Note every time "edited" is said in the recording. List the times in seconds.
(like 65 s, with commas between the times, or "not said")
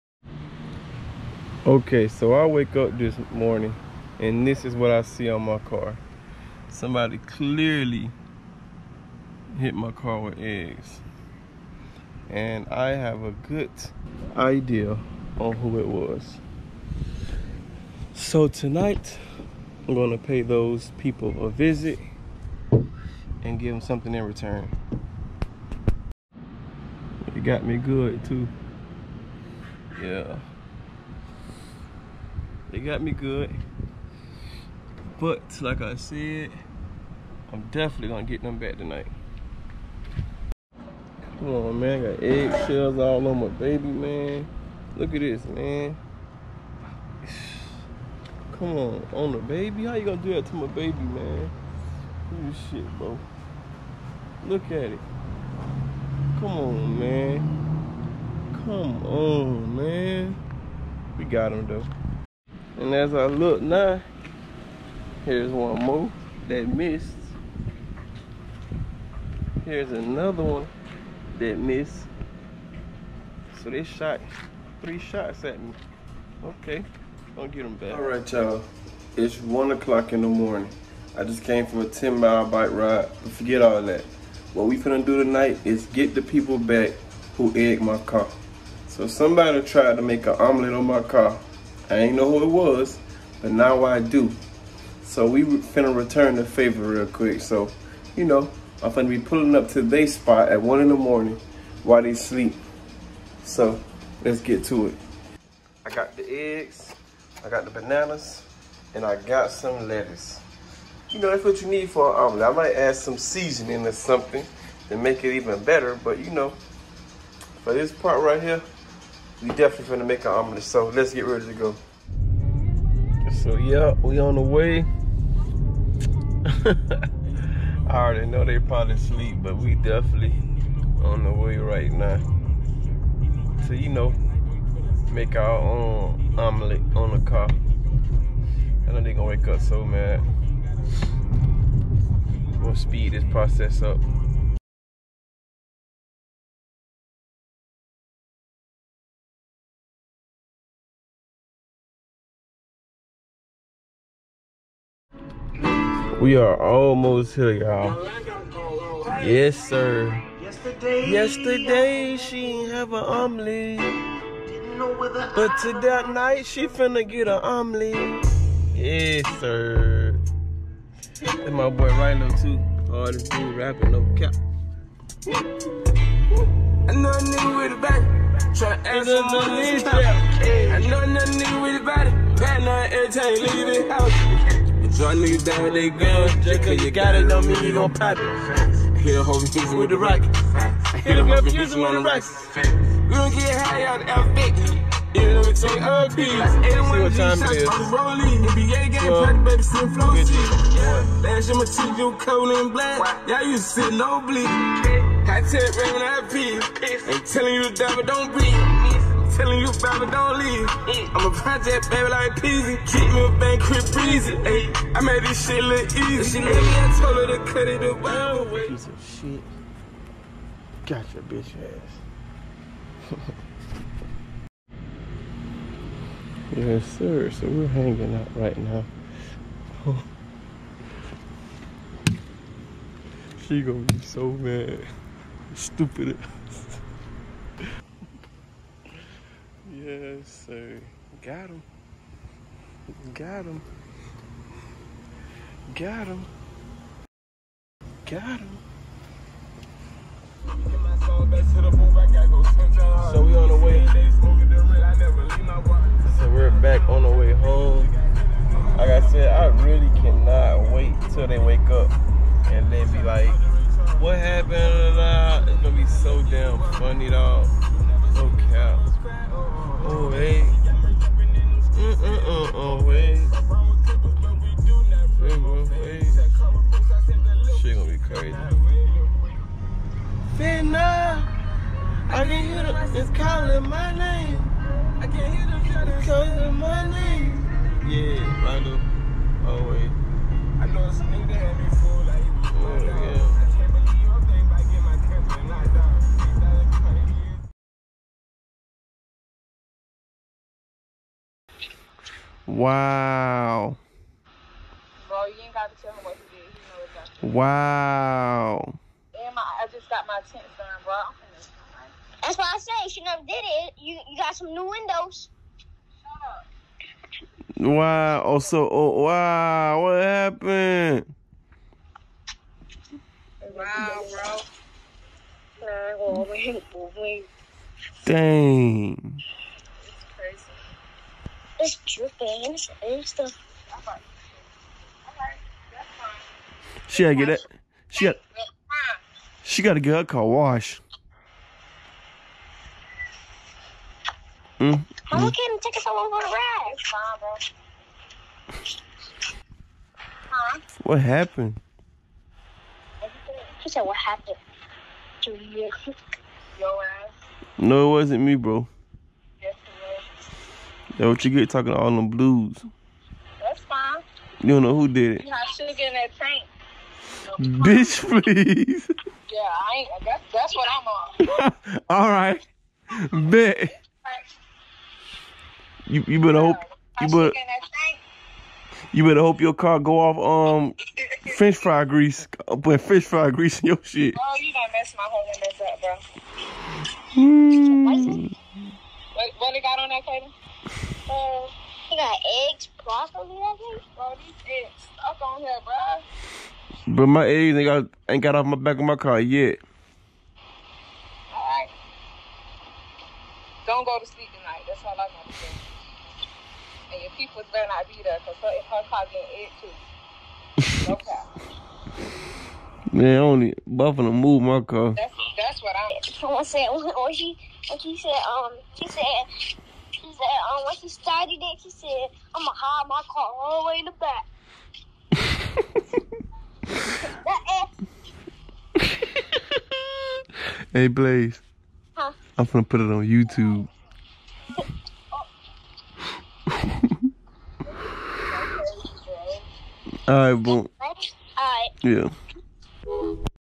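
not said.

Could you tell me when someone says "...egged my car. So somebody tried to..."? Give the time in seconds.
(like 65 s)
87 s.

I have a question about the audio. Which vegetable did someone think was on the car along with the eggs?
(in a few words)
broccoli.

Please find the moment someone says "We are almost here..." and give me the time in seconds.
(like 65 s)
156 s.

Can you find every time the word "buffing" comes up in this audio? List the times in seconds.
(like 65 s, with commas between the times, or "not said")
413 s.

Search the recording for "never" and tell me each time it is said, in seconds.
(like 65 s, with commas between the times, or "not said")
313 s.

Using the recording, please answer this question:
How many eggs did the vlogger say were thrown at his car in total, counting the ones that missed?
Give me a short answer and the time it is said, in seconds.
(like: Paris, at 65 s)
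3, at 74 s.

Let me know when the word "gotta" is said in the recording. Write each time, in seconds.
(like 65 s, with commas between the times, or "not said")
305 s, 337 s.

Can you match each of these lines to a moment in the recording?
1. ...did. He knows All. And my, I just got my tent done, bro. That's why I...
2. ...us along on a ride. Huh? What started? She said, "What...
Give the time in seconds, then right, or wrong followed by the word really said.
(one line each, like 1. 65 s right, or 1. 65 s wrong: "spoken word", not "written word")
1. 306 s wrong: "Wow", not "All"
2. 345 s wrong: "happened", not "started".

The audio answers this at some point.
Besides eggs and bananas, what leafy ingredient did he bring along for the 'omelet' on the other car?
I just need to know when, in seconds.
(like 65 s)
109 s.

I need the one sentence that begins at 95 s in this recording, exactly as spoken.
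So we finna return the favor real quick.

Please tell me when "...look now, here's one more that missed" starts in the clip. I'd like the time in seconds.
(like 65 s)
63 s.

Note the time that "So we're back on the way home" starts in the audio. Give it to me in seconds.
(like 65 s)
256 s.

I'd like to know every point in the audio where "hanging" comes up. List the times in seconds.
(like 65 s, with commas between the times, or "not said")
227 s.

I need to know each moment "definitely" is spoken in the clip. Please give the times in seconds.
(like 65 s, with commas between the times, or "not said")
37 s, 119 s, 129 s.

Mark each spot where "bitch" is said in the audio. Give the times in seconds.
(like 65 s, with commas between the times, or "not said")
221 s, 367 s.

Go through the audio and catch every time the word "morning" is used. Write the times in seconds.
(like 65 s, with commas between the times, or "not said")
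3 s, 80 s, 100 s.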